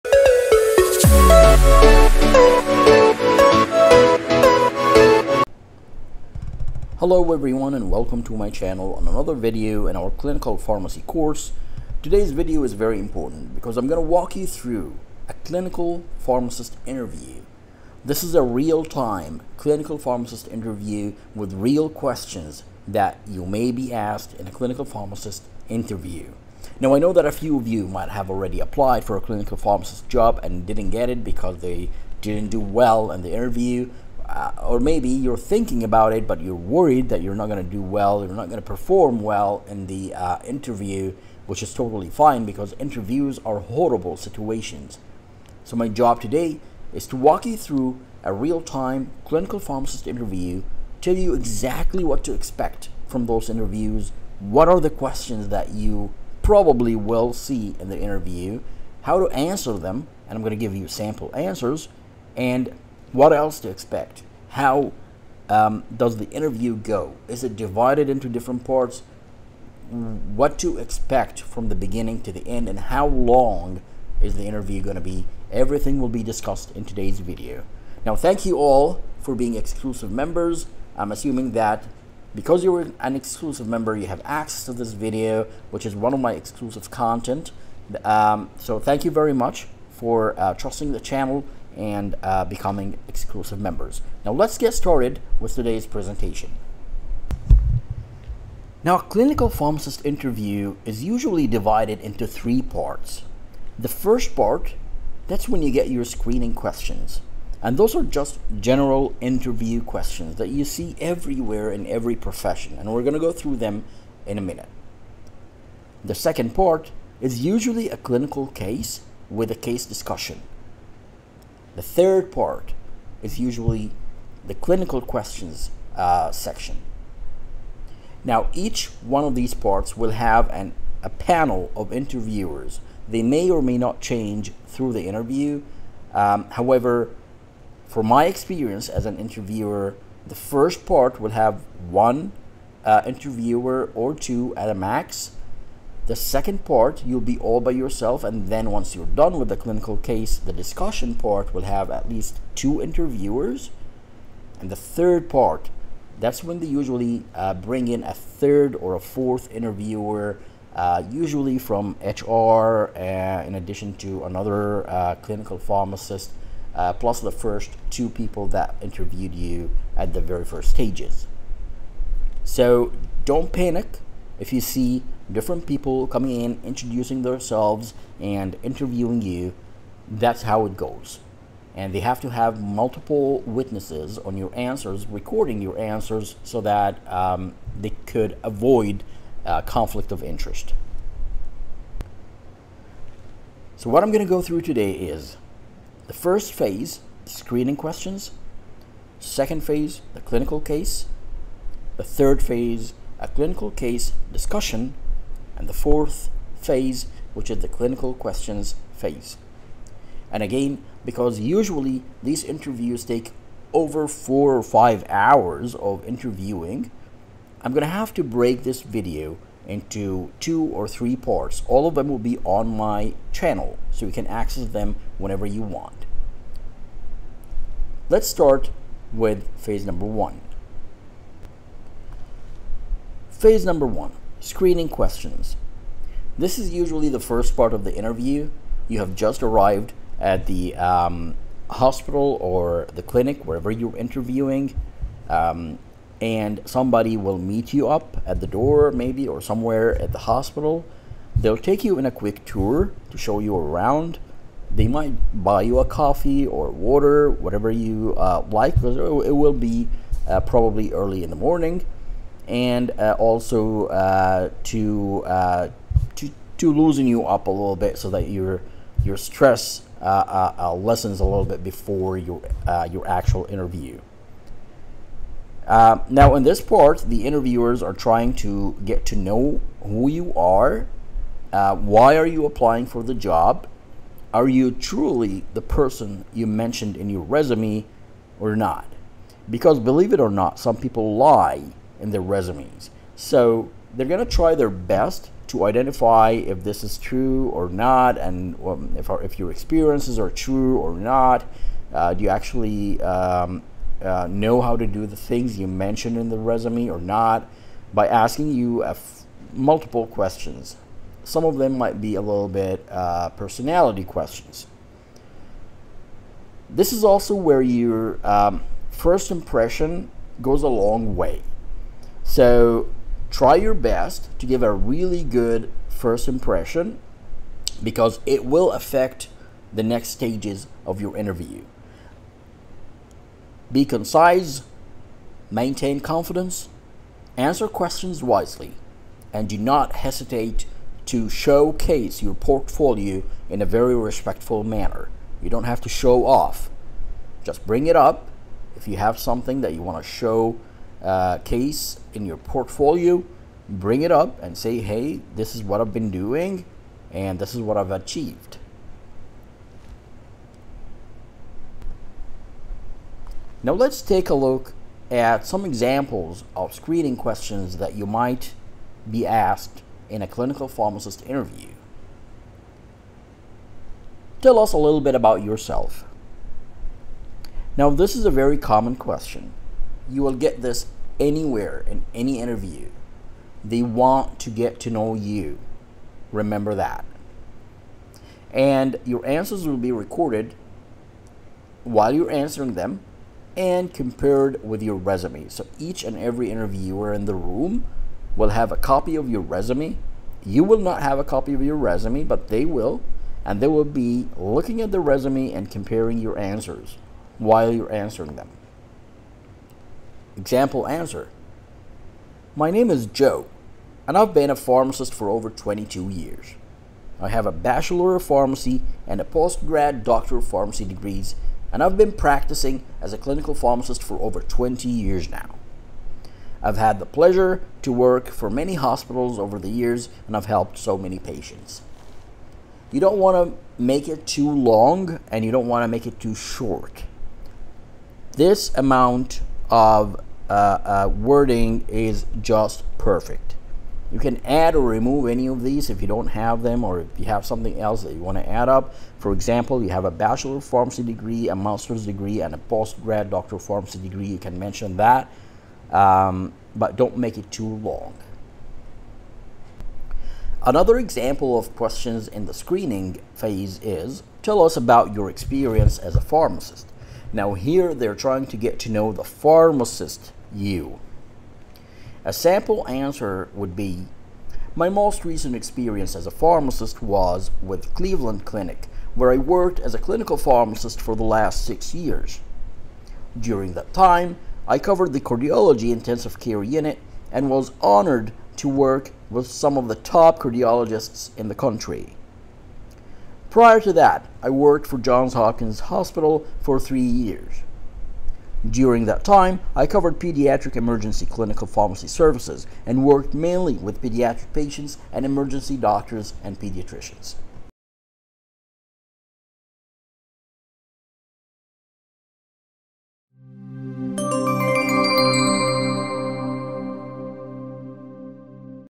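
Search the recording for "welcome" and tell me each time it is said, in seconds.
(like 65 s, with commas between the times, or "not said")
7 s.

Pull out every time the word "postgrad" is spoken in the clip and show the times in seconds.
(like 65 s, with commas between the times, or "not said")
419 s, 452 s.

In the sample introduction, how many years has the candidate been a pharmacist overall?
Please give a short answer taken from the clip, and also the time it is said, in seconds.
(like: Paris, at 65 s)
over 22 years, at 415 s.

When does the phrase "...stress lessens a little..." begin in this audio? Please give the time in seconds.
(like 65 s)
269 s.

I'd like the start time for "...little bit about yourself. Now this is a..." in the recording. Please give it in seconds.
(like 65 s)
374 s.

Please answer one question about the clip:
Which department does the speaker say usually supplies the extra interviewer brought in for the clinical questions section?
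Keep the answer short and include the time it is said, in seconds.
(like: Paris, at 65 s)
HR, at 162 s.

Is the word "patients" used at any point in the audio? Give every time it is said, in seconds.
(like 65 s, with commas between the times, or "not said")
431 s, 504 s.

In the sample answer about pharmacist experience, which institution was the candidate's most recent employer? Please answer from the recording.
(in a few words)
Cleveland Clinic.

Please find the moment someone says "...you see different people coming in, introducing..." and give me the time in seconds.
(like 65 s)
174 s.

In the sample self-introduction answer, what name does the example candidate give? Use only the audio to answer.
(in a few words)
Joe.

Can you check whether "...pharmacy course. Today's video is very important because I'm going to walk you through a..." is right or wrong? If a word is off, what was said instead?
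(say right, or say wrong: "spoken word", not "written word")
right.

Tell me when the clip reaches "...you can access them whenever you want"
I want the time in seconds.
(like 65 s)
224 s.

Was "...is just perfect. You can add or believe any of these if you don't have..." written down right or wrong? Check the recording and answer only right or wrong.
wrong.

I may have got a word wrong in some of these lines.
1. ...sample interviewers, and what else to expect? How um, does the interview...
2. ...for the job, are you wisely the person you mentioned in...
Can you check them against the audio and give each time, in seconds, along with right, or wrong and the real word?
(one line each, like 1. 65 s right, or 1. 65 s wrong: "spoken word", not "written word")
1. 60 s wrong: "answers", not "interviewers"
2. 282 s wrong: "truly", not "wisely".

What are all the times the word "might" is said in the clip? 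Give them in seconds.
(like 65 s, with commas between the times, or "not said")
27 s, 254 s, 311 s, 368 s.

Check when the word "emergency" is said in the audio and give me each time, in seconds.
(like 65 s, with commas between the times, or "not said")
500 s, 505 s.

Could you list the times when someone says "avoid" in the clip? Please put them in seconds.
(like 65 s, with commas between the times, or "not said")
188 s.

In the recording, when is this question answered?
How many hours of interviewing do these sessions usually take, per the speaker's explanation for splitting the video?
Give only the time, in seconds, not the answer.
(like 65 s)
214 s.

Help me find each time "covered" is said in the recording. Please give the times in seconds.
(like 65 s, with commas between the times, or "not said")
484 s, 499 s.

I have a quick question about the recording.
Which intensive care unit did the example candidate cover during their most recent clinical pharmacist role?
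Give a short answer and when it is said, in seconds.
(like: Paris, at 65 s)
cardiology intensive care unit, at 485 s.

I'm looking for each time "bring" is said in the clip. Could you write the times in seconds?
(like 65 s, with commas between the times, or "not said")
157 s, 347 s, 353 s.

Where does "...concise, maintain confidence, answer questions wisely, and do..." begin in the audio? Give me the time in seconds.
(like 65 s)
333 s.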